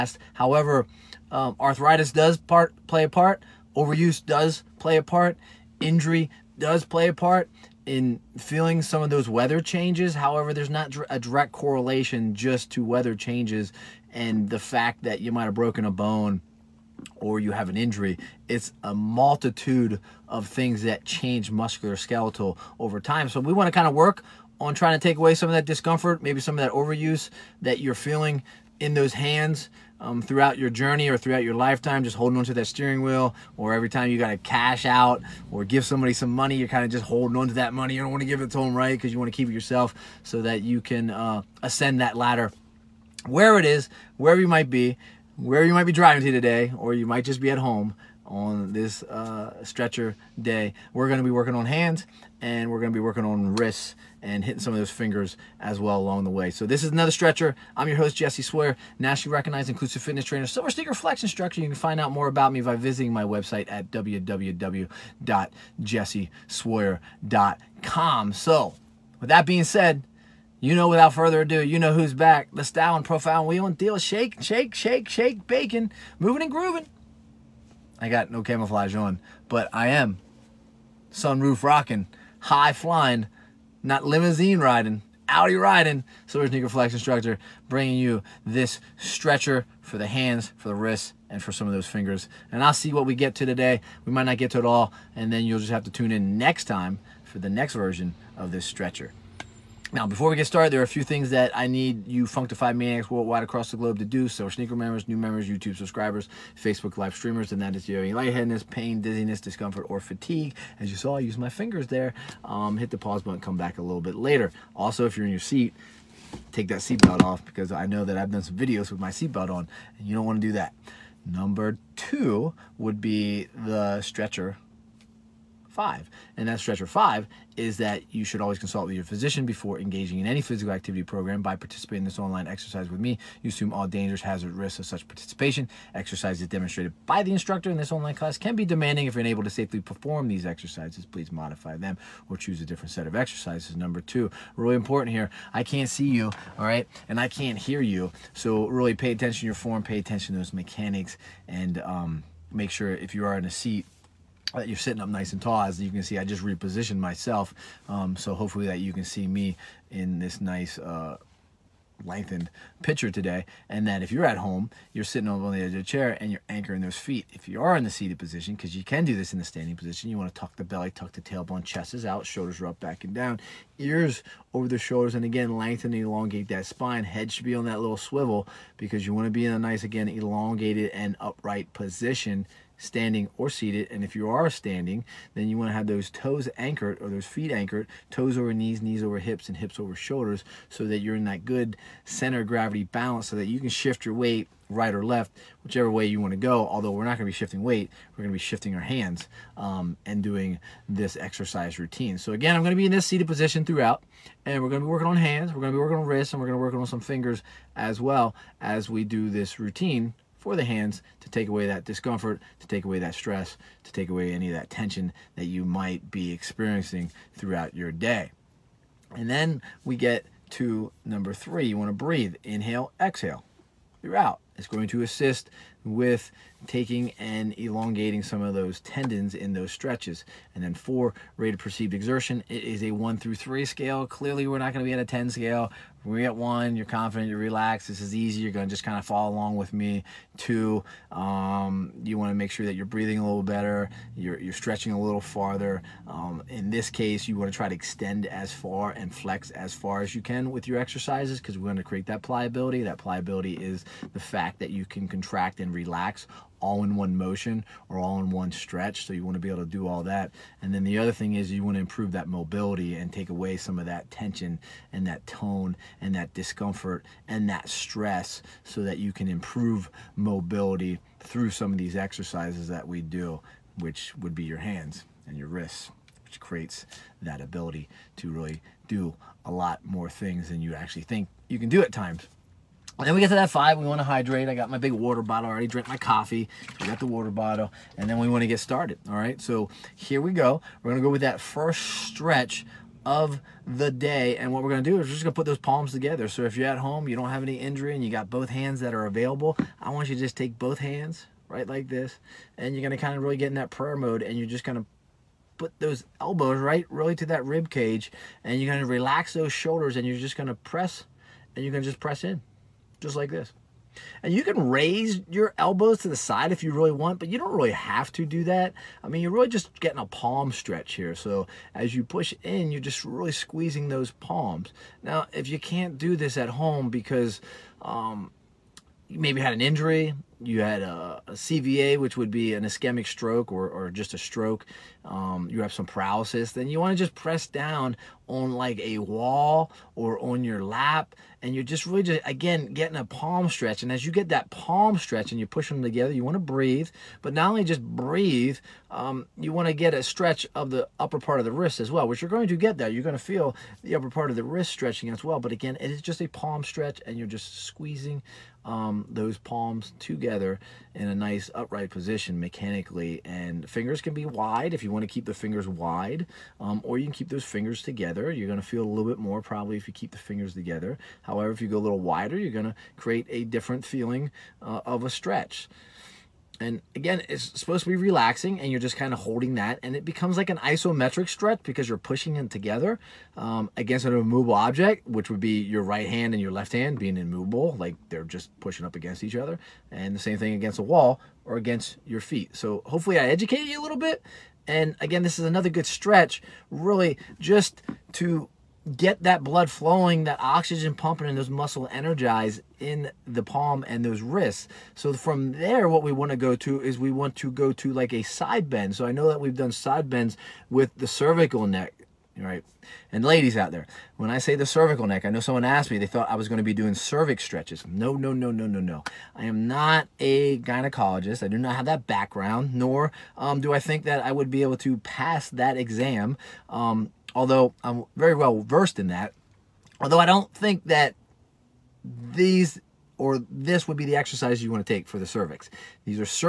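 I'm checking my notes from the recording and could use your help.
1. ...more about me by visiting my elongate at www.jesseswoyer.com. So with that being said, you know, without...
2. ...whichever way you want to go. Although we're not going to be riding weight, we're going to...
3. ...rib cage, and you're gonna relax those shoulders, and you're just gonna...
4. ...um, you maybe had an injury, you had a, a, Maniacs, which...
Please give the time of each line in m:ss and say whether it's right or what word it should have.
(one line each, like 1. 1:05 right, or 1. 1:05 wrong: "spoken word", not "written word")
1. 1:02 wrong: "website", not "elongate"
2. 3:15 wrong: "shifting", not "riding"
3. 5:07 right
4. 5:27 wrong: "CVA", not "Maniacs".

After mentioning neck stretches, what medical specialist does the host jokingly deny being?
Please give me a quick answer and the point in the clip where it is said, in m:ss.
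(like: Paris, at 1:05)
gynecologist, at 7:00.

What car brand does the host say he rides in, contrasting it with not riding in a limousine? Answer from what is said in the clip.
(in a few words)
Audi.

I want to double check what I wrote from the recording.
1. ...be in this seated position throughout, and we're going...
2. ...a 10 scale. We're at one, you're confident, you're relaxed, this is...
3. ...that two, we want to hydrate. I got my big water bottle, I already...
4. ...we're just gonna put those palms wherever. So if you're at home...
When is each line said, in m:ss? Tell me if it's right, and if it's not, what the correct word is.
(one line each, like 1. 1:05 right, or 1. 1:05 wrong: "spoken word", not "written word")
1. 3:22 right
2. 3:54 right
3. 4:43 wrong: "five", not "two"
4. 4:55 wrong: "together", not "wherever".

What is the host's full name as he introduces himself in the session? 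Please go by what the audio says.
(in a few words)
Jesse Swoyer.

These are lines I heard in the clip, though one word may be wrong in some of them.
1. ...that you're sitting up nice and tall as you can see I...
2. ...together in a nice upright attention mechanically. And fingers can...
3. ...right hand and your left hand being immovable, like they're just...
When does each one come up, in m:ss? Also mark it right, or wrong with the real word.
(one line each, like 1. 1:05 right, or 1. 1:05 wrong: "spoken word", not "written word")
1. 2:34 right
2. 5:59 wrong: "position", not "attention"
3. 6:25 right.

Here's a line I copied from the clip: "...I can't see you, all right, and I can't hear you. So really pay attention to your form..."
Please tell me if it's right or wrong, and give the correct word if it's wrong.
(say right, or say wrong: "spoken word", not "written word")
right.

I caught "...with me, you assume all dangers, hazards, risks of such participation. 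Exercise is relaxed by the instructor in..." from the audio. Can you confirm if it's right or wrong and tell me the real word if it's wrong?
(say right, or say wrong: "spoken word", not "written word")
wrong: "demonstrated", not "relaxed".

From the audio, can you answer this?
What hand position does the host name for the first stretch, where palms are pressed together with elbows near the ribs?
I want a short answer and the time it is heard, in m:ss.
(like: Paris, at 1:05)
prayer mode, at 5:03.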